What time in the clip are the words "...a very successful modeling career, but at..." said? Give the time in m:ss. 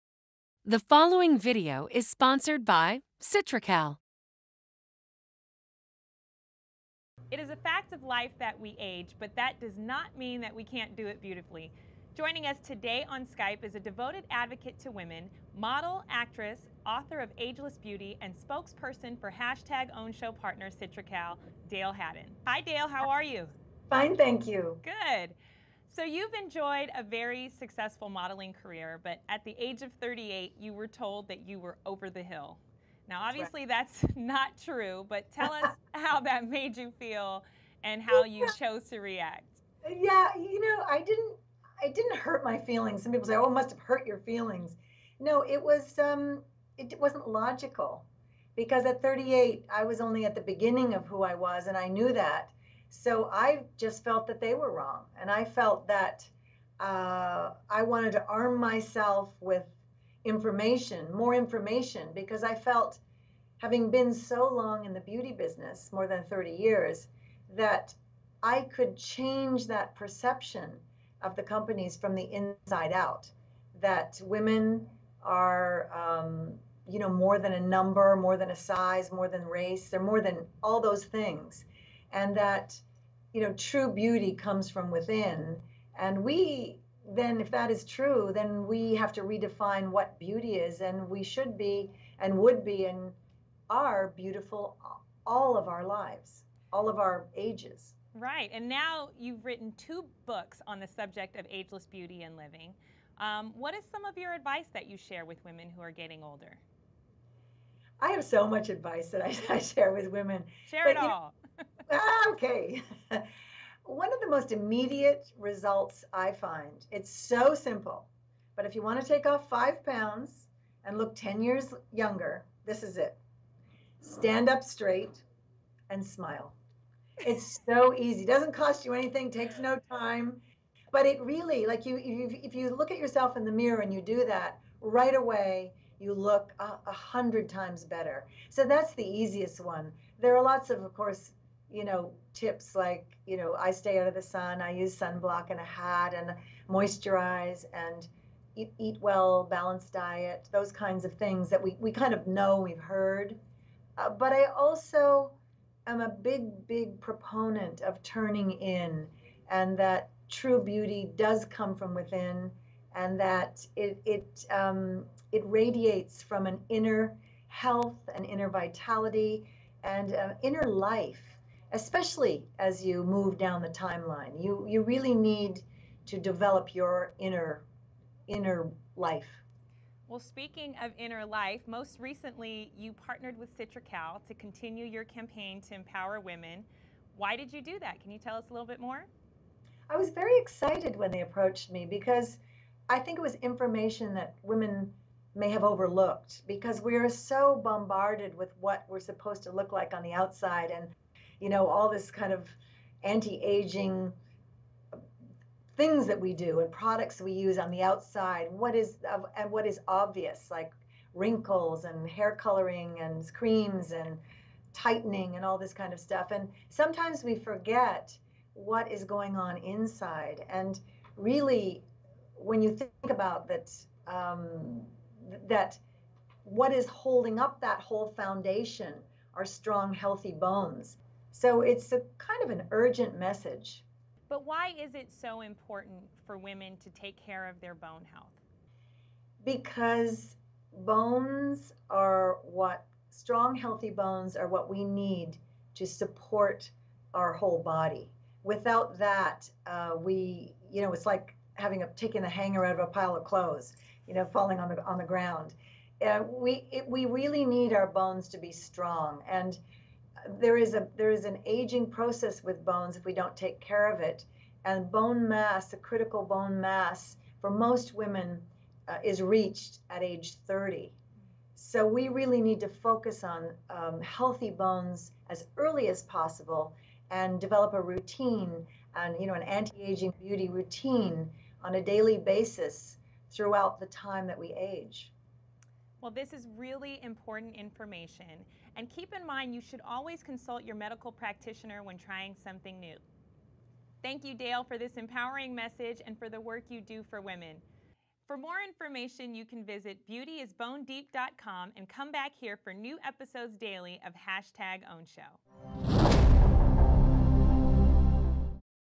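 0:26.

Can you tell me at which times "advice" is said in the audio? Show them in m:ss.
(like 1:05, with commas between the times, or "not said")
1:44, 1:48.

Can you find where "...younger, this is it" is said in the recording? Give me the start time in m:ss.
2:01.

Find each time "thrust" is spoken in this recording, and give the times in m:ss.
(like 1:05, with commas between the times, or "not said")
not said.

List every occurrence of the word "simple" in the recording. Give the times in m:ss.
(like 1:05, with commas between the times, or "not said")
1:57.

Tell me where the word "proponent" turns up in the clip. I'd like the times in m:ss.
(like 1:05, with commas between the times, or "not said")
2:36.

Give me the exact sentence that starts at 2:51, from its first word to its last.
Especially as you move down the timeline, you you really need to develop your inner inner life.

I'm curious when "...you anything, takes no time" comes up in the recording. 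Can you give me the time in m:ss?
2:08.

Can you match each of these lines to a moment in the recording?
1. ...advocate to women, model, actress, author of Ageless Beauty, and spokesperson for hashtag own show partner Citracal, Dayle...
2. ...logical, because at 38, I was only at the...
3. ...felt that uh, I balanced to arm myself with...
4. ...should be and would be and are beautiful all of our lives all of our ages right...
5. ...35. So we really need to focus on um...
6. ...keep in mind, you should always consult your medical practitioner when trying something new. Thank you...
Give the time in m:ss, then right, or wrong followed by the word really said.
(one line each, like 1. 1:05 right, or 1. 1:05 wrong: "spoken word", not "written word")
1. 0:14 right
2. 0:47 right
3. 0:55 wrong: "wanted", not "balanced"
4. 1:31 right
5. 4:30 wrong: "30", not "35"
6. 4:48 right.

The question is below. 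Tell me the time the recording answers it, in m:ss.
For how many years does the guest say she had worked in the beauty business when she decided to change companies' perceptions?
1:05.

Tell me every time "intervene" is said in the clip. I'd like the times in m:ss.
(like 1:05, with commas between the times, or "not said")
not said.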